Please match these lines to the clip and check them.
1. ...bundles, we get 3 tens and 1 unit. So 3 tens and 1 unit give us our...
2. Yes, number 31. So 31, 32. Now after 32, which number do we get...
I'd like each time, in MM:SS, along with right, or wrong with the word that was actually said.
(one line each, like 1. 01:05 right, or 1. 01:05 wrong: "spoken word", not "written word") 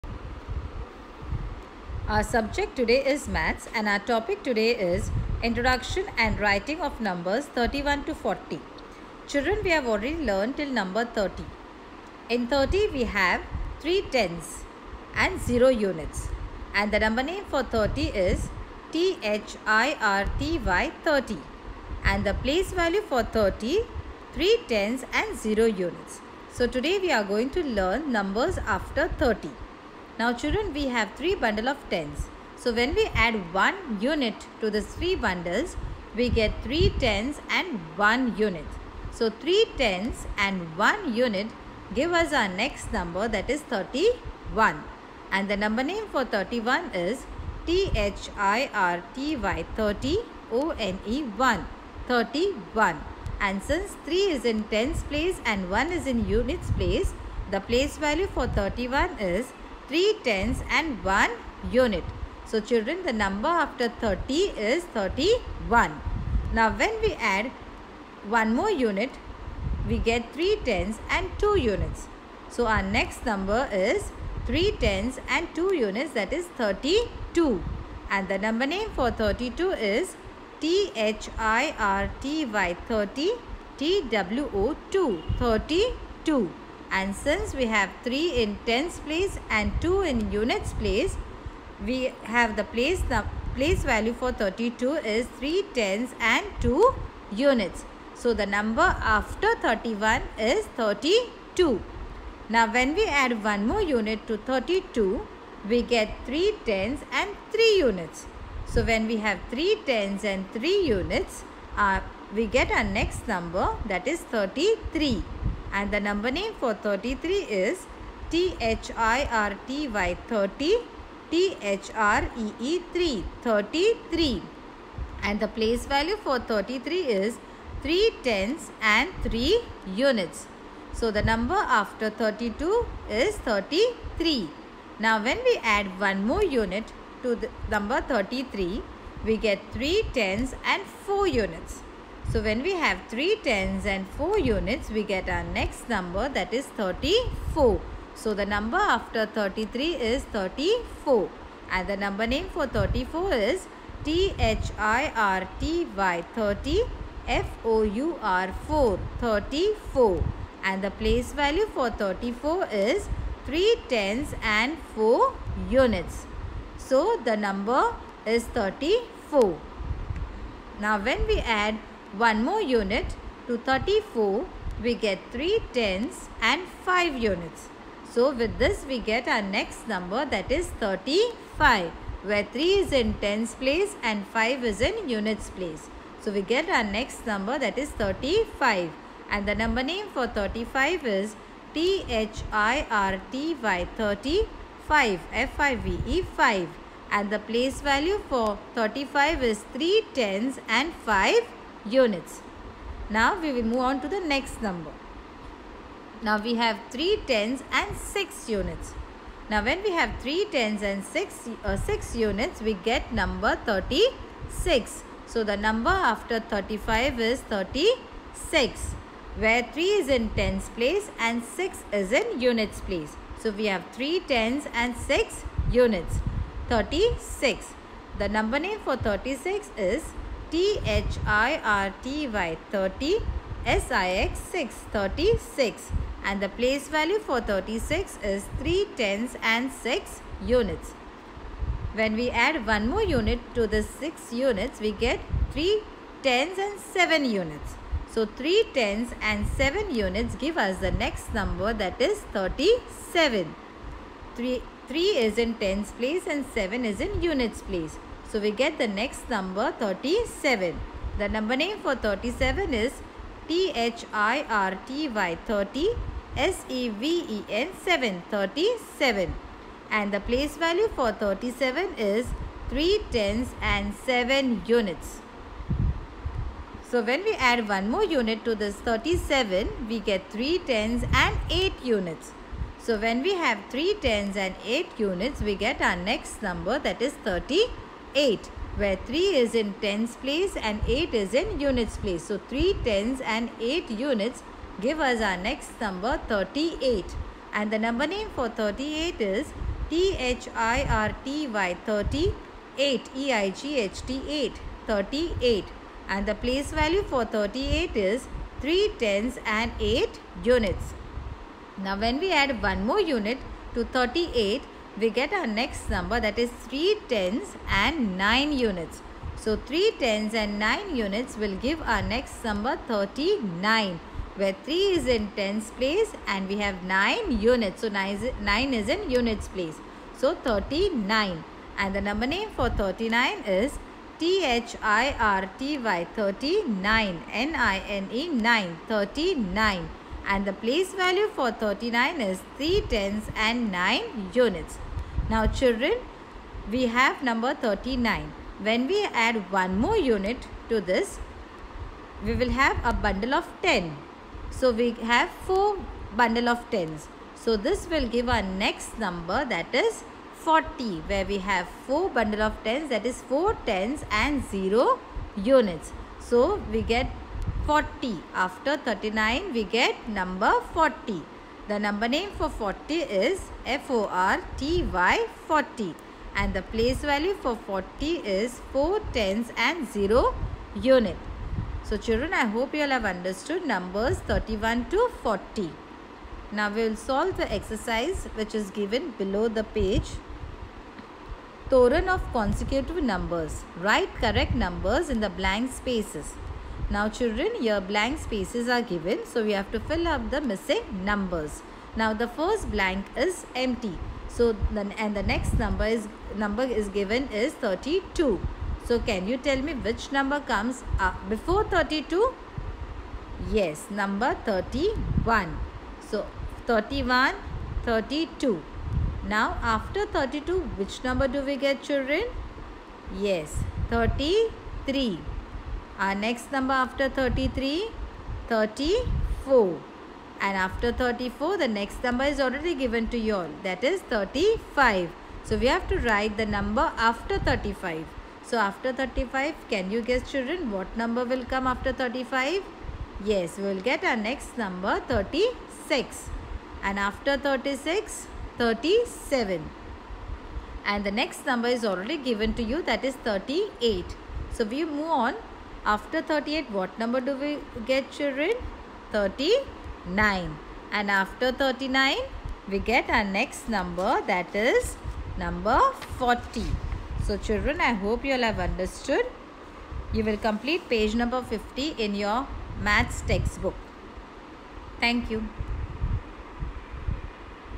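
1. 00:35 right
2. 06:53 right.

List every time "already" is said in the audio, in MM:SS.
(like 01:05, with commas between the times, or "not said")
00:09, 07:12, 07:31.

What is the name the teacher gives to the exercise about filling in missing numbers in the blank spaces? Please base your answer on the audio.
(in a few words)
Toran of consecutive numbers.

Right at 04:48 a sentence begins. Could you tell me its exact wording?
8 where 3 is in tens place and 8 is in units place.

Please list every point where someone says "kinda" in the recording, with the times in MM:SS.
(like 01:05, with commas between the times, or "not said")
not said.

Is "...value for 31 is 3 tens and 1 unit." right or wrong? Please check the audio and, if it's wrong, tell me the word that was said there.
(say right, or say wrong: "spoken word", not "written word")
right.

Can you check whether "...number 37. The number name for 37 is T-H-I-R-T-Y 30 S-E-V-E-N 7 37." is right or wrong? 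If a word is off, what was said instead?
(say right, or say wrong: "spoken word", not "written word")
right.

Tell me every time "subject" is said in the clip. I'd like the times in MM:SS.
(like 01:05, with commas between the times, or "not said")
00:02.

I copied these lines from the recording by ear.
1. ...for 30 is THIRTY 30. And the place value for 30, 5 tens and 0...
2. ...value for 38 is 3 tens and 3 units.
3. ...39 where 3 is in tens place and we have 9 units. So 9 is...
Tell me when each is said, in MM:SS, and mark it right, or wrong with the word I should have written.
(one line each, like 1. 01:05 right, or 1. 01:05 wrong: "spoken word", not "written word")
1. 00:17 wrong: "3", not "5"
2. 05:06 wrong: "8", not "3"
3. 05:22 right.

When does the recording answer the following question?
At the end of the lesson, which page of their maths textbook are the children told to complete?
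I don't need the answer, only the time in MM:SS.
07:50.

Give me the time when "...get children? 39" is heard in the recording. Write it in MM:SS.
07:37.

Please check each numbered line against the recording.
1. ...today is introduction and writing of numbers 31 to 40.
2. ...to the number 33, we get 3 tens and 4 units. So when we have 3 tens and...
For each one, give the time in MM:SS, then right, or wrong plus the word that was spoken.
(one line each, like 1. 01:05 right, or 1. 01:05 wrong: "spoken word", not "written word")
1. 00:04 right
2. 02:17 right.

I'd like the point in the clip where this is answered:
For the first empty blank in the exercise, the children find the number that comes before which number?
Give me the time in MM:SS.
06:46.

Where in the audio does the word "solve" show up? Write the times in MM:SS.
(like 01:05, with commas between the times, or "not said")
06:26.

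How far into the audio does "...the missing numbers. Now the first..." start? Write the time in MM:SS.
06:40.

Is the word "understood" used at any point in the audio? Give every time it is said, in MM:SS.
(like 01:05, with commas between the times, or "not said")
06:23, 07:48.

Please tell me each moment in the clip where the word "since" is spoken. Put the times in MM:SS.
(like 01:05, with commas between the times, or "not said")
00:53, 01:27.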